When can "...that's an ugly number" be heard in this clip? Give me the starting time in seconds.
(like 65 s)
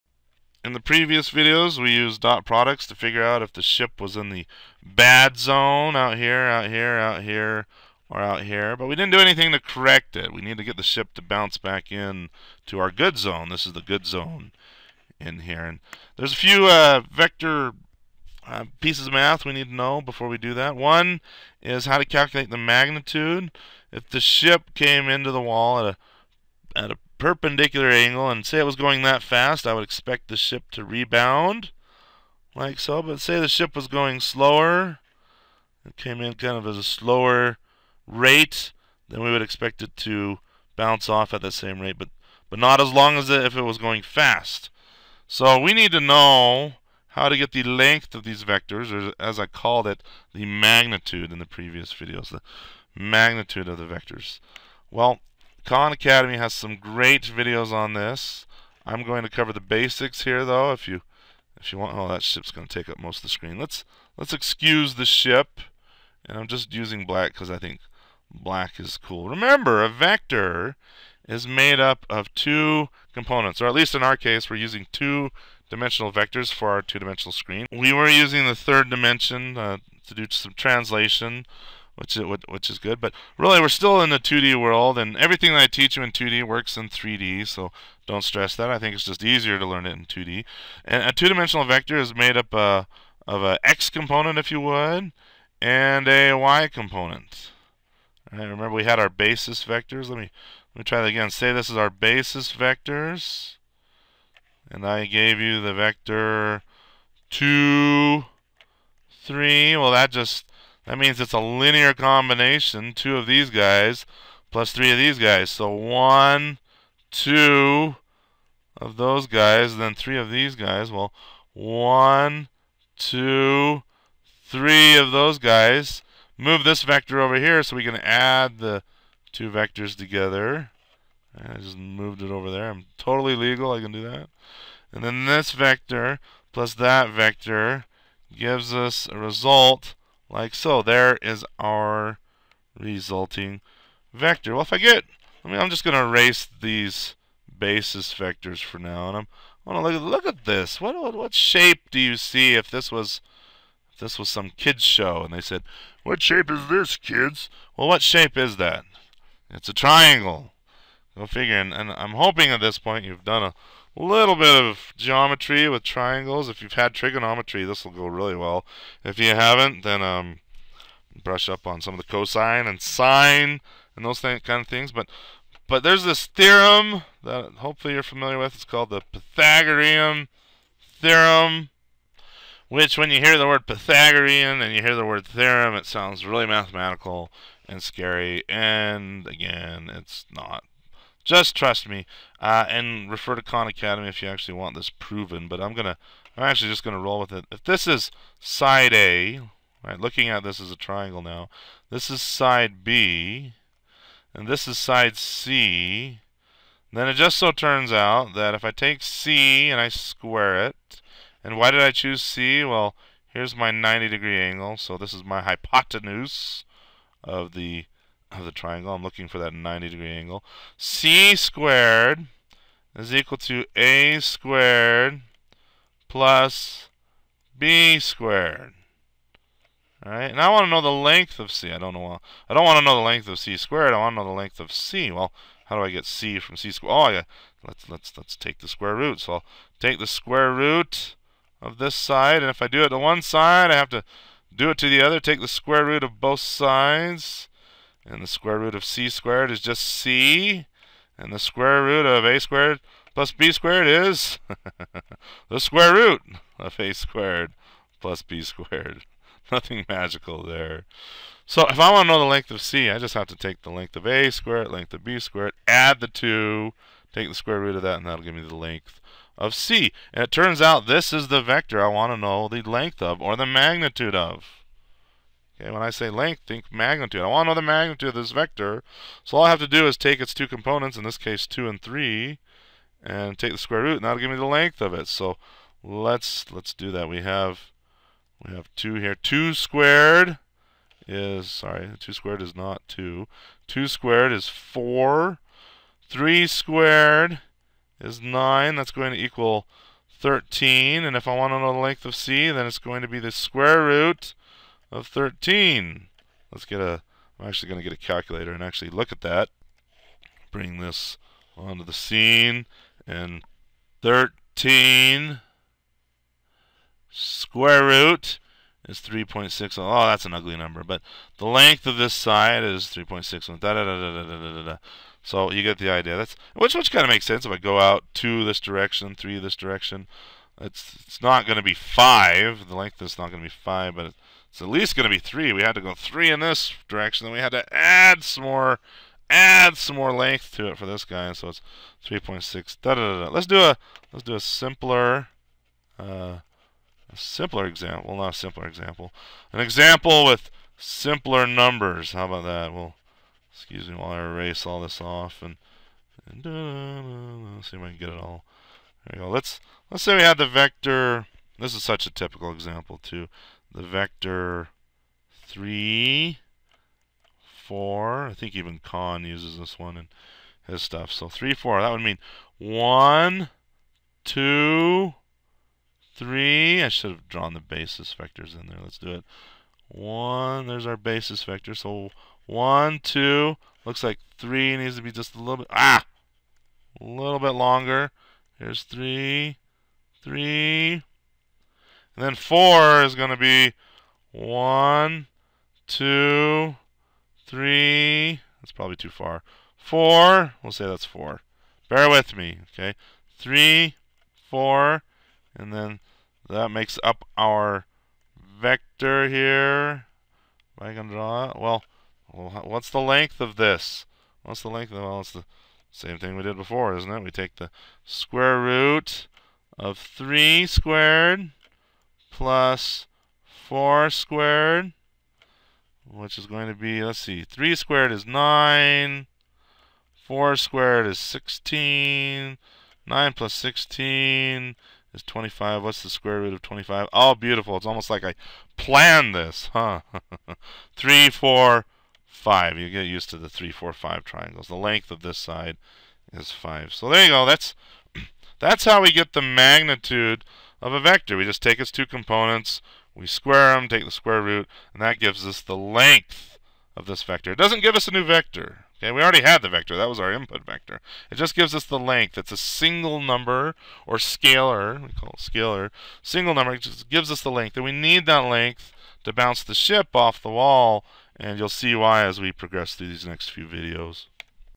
320 s.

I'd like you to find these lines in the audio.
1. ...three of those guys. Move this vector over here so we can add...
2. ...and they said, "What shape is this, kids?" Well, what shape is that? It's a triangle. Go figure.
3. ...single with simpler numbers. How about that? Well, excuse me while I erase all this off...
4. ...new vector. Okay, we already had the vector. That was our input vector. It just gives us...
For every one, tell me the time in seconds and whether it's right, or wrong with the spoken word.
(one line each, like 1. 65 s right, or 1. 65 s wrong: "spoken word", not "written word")
1. 124 s right
2. 155 s right
3. 349 s wrong: "example", not "single"
4. 458 s right.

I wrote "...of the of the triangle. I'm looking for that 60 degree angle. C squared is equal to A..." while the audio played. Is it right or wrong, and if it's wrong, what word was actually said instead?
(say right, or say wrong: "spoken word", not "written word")
wrong: "90", not "60".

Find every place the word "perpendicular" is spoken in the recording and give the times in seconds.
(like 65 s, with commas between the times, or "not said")
27 s.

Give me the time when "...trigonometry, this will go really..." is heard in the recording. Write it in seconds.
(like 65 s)
166 s.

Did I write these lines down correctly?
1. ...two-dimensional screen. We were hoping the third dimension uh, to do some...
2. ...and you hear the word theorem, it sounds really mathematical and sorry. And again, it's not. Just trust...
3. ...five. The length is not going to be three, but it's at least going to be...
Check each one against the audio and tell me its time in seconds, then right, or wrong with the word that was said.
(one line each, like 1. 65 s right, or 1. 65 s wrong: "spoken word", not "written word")
1. 76 s wrong: "using", not "hoping"
2. 184 s wrong: "scary", not "sorry"
3. 331 s wrong: "five", not "three".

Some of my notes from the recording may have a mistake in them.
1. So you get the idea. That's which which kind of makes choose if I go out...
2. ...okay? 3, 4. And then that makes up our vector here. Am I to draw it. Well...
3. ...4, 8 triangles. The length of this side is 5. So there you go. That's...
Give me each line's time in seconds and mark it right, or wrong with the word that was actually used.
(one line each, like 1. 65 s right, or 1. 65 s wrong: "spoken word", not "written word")
1. 325 s wrong: "sense", not "choose"
2. 402 s right
3. 443 s wrong: "5", not "8".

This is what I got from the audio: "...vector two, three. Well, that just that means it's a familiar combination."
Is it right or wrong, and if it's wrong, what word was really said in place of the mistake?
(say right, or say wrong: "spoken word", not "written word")
wrong: "linear", not "familiar".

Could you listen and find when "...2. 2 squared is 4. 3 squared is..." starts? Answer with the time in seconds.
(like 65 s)
292 s.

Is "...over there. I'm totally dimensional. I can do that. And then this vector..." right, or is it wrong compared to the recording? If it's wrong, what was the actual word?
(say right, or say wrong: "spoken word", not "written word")
wrong: "legal", not "dimensional".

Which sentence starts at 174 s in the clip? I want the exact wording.
But but there's this theorem that hopefully you're familiar with.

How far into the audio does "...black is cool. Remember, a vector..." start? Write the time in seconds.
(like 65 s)
68 s.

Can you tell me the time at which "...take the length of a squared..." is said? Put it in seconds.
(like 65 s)
263 s.